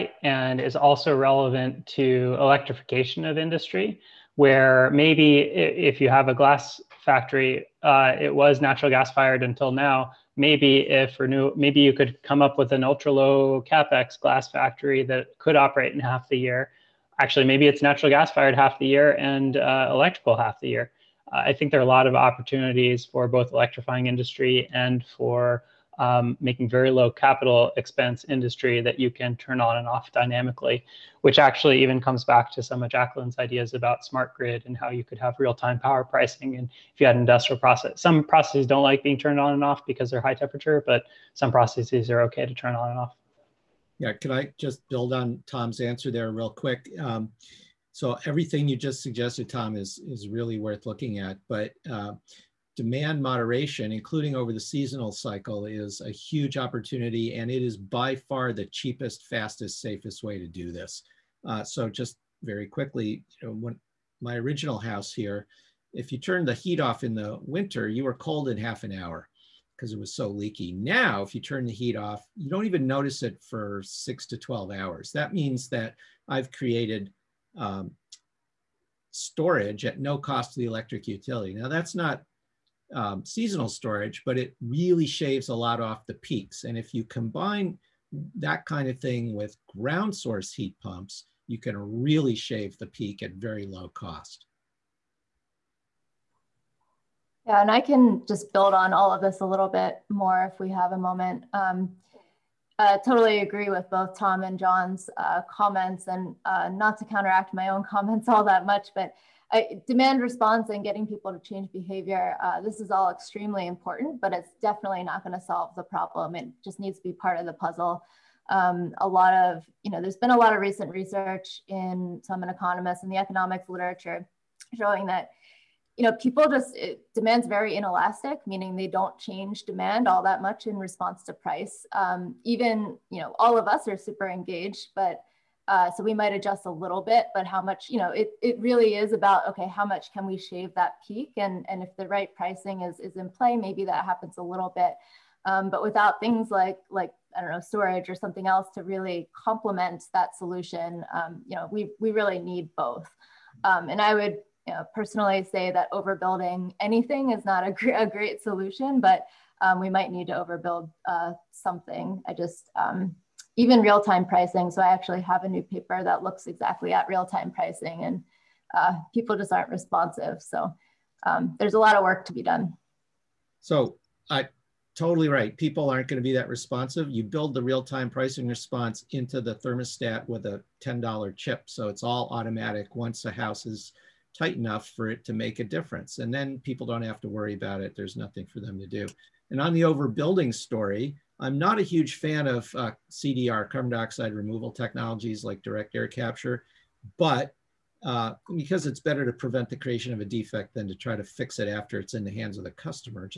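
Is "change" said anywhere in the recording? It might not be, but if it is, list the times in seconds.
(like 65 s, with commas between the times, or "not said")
111 s, 129 s.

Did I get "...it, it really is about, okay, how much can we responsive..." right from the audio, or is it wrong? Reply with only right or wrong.
wrong.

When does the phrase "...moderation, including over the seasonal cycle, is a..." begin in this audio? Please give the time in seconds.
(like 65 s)
53 s.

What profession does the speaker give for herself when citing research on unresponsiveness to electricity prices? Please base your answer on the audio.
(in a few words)
economist.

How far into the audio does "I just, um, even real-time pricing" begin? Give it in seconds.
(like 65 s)
162 s.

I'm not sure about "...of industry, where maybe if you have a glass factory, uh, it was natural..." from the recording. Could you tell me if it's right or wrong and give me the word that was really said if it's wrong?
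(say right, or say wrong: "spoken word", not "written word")
right.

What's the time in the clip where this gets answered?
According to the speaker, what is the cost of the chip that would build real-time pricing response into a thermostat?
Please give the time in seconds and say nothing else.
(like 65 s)
180 s.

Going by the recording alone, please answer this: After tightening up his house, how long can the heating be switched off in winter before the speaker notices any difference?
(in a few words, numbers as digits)
6 to 12 hours.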